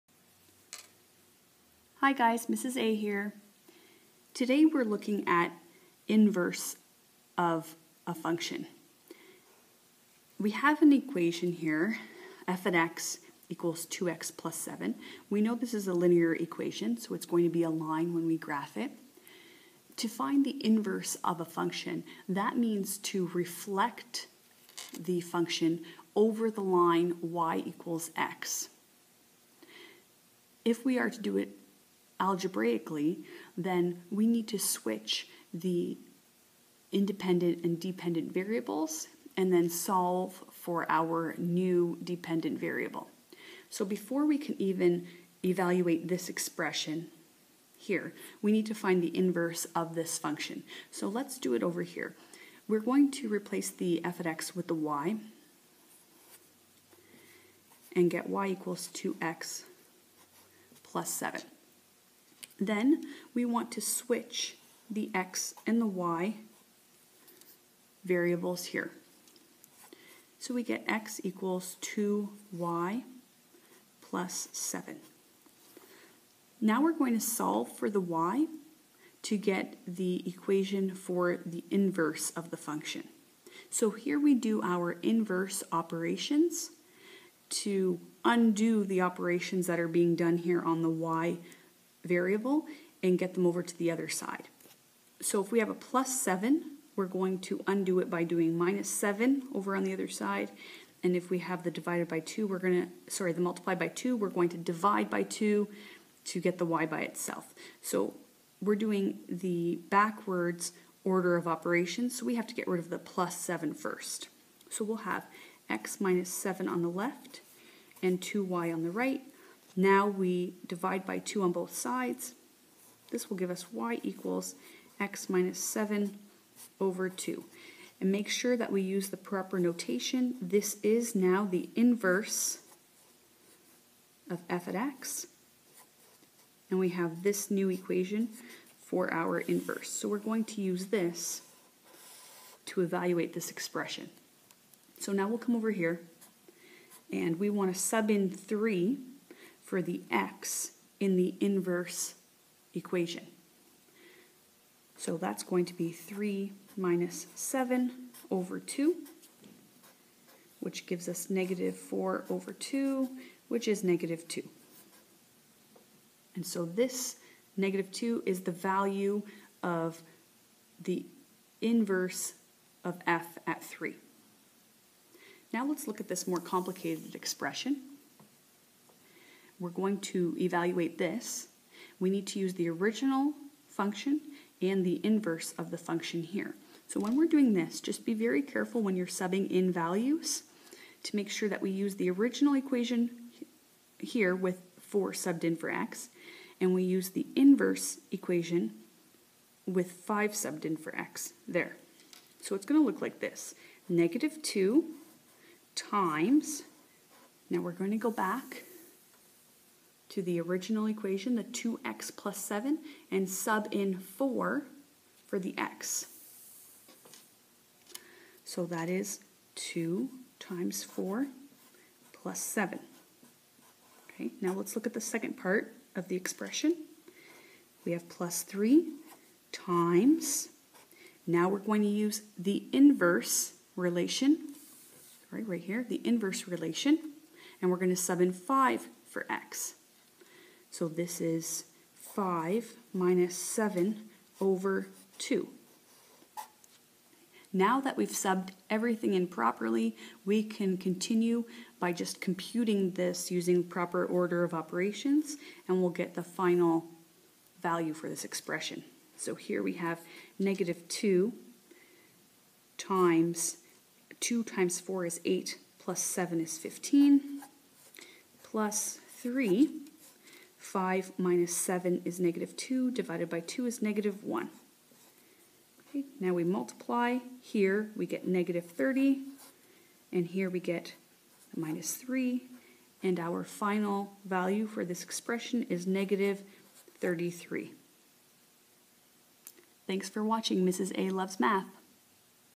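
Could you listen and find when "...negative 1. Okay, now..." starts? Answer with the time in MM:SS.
04:33.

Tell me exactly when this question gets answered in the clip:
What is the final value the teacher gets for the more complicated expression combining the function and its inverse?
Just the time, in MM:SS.
04:45.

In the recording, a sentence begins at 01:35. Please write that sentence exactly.
So if we have a plus 7, we're going to undo it by doing minus 7 over on the other side.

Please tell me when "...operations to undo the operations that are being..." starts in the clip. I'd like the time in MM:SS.
01:25.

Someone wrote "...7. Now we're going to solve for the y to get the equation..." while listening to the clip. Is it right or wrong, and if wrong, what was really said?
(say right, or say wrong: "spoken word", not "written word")
right.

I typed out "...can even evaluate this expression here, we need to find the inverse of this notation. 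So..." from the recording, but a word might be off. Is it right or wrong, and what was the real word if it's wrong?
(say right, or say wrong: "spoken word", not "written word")
wrong: "function", not "notation".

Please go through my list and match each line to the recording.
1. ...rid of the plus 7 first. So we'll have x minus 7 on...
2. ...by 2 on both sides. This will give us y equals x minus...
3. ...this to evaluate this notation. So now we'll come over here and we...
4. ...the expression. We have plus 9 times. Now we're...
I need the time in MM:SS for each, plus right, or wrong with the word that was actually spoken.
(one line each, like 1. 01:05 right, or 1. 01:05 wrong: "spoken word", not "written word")
1. 01:52 right
2. 02:01 right
3. 02:20 wrong: "expression", not "notation"
4. 03:46 wrong: "3", not "9".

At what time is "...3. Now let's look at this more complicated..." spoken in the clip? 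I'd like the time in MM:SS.
02:53.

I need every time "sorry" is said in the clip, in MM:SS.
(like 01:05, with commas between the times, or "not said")
01:43, 03:55.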